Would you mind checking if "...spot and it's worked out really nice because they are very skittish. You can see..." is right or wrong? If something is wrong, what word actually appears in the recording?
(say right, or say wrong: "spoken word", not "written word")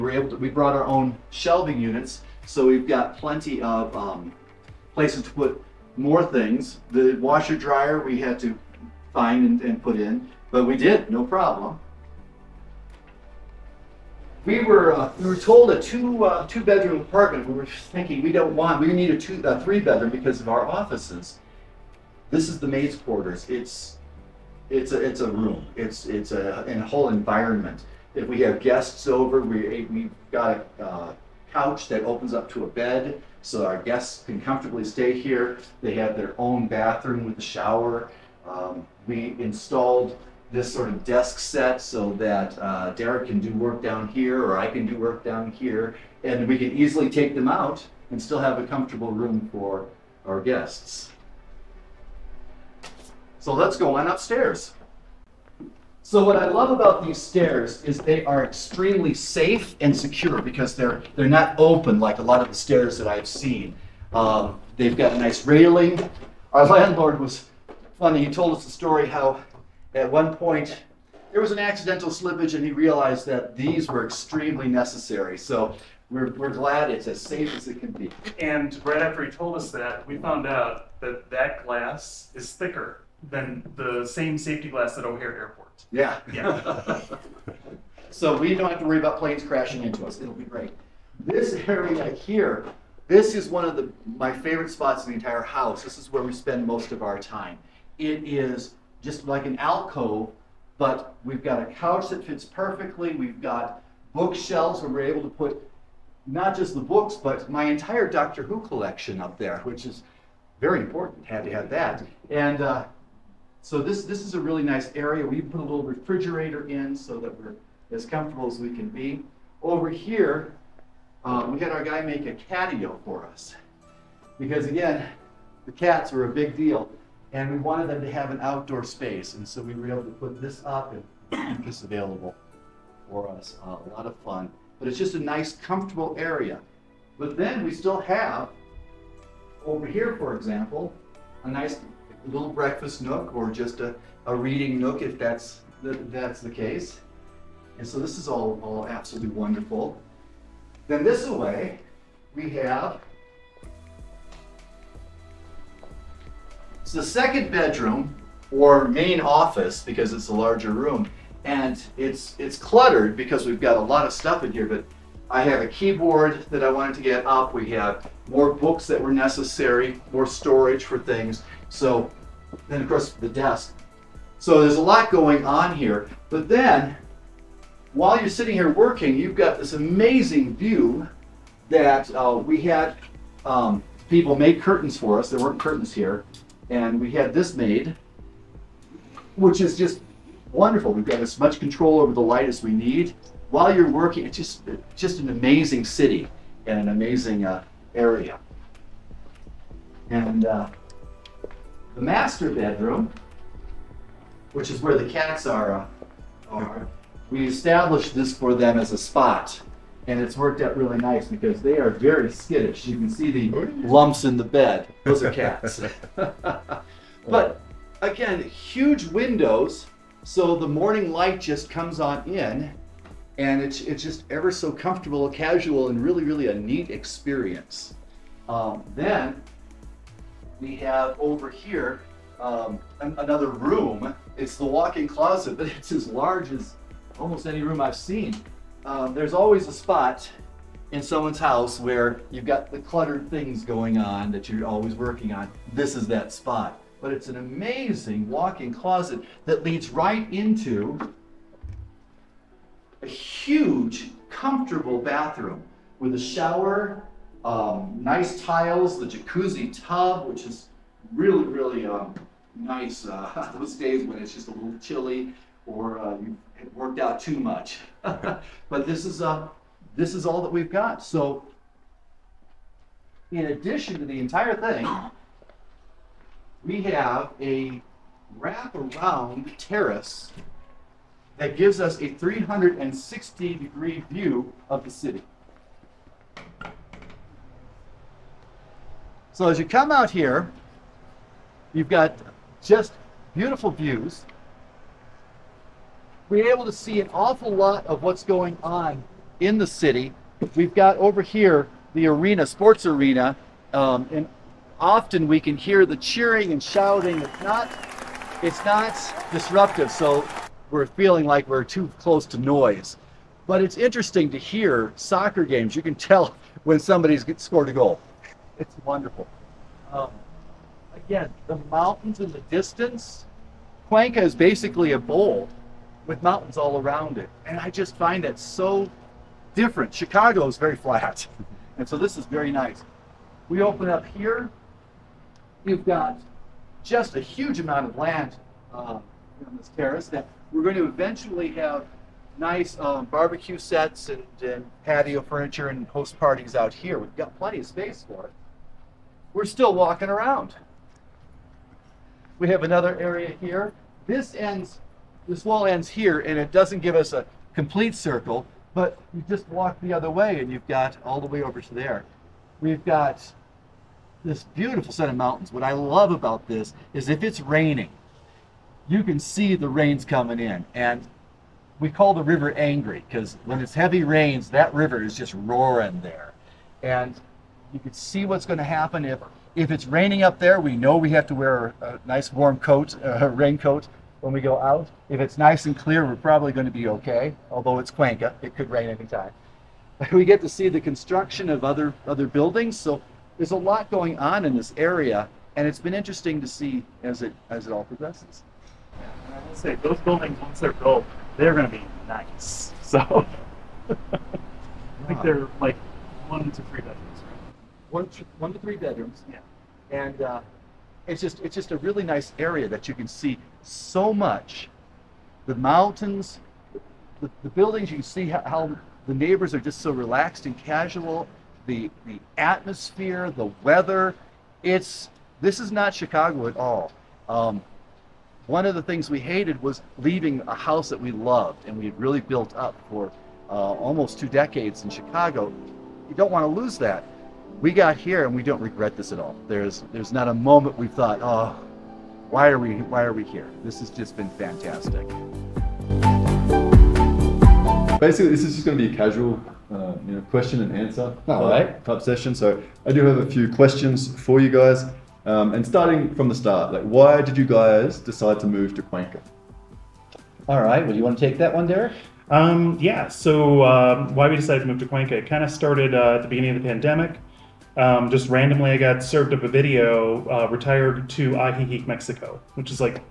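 right.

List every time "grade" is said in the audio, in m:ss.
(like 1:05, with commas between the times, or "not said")
not said.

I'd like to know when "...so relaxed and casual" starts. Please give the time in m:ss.
6:59.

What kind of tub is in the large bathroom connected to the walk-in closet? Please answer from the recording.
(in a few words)
Jacuzzi tub.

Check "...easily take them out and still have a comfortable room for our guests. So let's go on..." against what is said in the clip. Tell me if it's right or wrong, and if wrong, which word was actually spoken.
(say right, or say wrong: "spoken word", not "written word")
right.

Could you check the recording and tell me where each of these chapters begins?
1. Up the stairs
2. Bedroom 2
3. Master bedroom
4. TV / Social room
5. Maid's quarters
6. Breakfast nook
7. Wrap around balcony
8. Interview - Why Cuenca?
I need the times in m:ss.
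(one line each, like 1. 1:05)
1. 0:55
2. 2:29
3. 3:19
4. 1:24
5. 0:13
6. 2:16
7. 4:32
8. 7:26.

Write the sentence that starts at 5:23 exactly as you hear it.
Cuenca is basically a bowl with mountains all around it.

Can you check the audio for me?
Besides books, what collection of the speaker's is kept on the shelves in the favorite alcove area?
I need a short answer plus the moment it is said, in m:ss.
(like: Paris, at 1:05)
Doctor Who collection, at 1:48.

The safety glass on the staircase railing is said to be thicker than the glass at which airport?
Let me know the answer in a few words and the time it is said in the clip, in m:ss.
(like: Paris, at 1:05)
O'Hare Airport, at 1:25.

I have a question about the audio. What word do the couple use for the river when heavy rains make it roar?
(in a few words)
Angry.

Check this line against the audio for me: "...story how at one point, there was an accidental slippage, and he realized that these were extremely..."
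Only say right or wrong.
right.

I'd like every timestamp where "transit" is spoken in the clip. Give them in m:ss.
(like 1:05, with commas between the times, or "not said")
not said.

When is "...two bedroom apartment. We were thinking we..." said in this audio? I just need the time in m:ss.
0:16.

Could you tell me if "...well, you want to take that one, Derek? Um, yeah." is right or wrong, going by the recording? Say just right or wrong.
right.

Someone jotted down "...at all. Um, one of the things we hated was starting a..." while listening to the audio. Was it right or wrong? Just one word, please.
wrong.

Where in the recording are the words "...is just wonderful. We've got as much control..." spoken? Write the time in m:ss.
3:09.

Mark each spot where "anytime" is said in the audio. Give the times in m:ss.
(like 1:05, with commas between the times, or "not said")
6:28.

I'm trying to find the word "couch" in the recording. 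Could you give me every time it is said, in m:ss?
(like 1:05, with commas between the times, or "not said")
0:31, 1:41.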